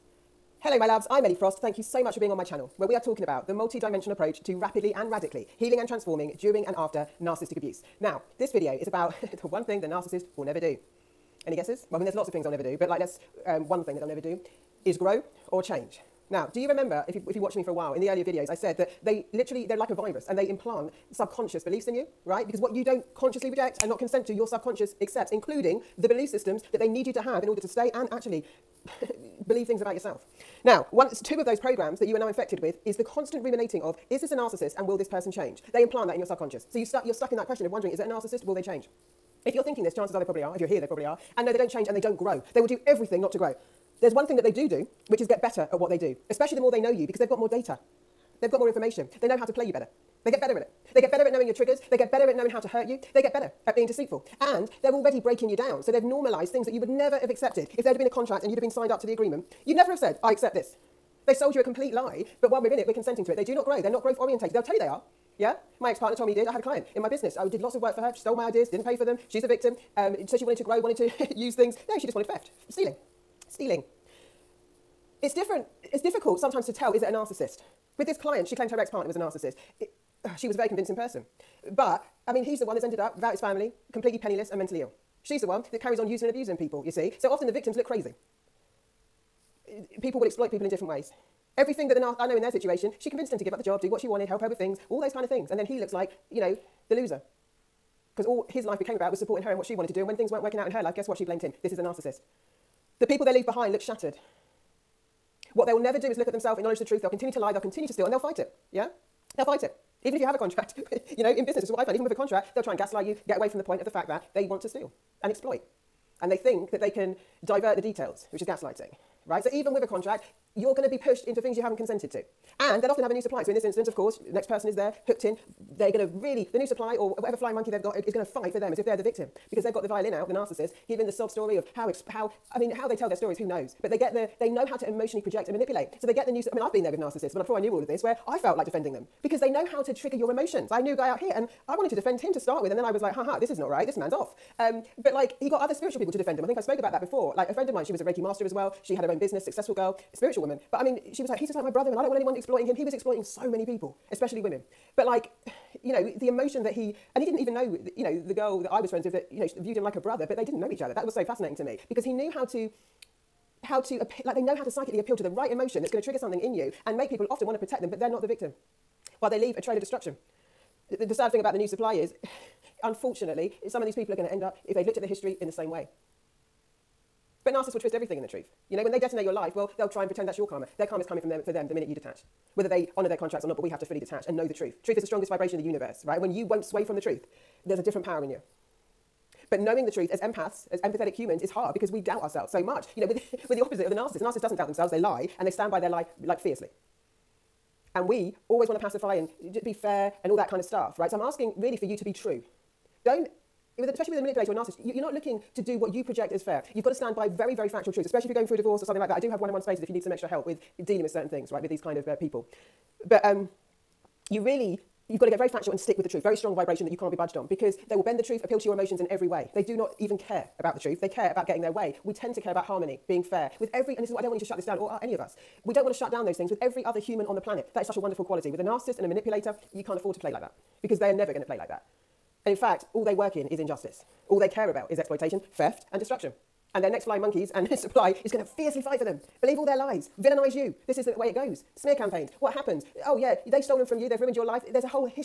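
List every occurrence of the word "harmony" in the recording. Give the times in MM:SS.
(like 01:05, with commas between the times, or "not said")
03:42.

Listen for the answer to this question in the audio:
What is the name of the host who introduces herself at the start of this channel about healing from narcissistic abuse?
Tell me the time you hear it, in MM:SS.
00:01.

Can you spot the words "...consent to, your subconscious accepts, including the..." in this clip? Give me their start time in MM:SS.
00:23.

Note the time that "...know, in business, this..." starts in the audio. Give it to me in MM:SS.
01:51.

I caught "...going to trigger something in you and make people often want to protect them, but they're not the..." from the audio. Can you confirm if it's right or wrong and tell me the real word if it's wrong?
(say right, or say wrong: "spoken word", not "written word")
right.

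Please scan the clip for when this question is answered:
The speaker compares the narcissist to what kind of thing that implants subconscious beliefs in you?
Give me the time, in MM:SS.
00:19.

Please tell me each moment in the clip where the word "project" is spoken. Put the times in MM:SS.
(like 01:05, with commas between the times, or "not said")
02:15, 03:26.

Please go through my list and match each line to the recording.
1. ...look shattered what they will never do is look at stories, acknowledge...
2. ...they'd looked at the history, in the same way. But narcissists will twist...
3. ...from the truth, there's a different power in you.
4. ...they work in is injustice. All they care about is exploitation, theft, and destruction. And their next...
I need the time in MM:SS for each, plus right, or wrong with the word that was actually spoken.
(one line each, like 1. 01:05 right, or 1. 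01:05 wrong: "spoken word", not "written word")
1. 01:43 wrong: "themselves", not "stories"
2. 02:54 right
3. 03:06 right
4. 03:53 right.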